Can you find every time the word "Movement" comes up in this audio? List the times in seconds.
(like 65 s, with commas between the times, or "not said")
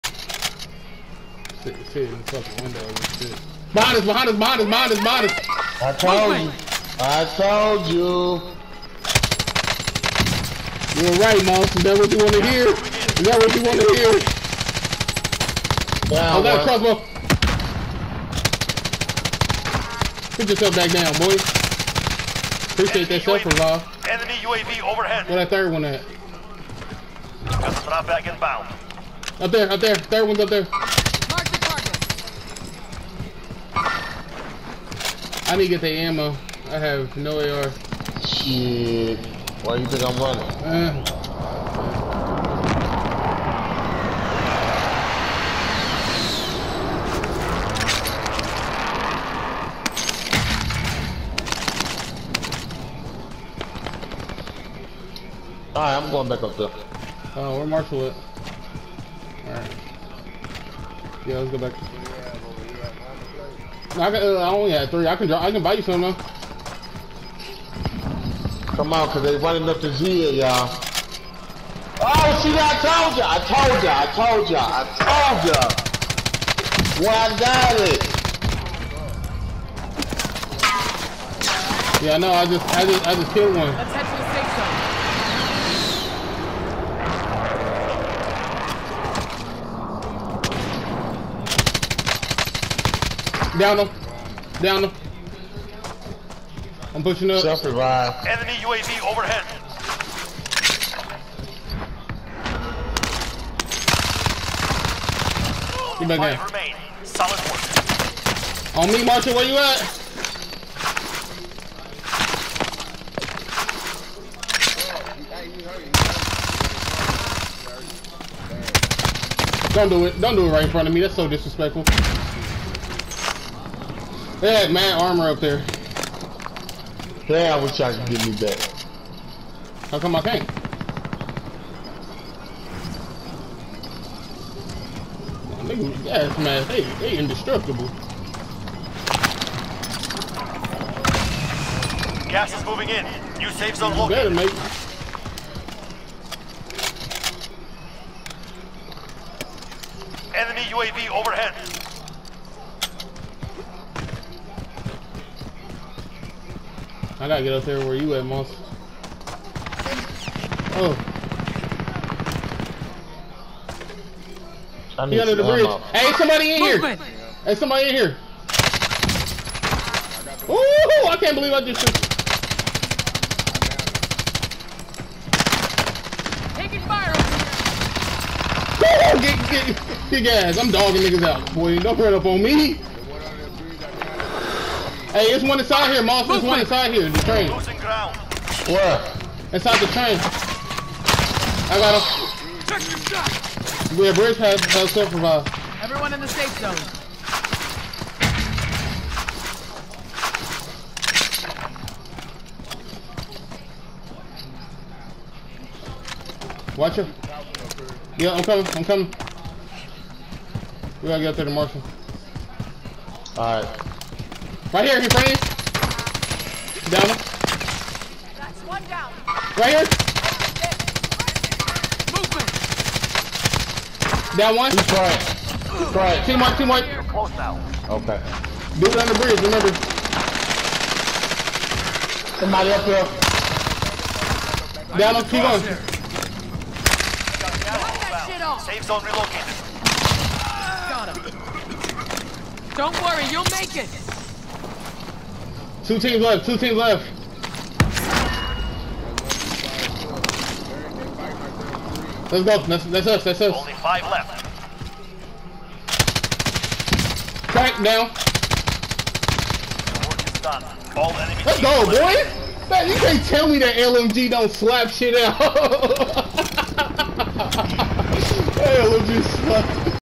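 166 s, 222 s.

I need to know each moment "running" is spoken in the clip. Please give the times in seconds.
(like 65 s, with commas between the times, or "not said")
40 s, 69 s.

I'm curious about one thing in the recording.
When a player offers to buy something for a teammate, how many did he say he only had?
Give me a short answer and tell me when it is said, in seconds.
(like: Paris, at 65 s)
3, at 64 s.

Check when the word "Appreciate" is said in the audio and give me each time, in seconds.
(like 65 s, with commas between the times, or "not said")
22 s.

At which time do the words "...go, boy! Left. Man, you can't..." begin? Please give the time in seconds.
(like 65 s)
261 s.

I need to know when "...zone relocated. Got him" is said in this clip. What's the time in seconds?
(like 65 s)
238 s.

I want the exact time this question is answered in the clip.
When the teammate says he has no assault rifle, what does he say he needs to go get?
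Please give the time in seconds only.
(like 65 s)
33 s.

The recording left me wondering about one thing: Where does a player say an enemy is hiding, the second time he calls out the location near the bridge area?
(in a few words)
Inside the train.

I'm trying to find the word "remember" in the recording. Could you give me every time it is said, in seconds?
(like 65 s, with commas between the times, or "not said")
229 s.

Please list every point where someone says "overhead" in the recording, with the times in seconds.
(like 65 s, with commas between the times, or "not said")
24 s, 99 s, 151 s.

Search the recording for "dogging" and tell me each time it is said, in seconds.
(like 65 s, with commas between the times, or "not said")
180 s.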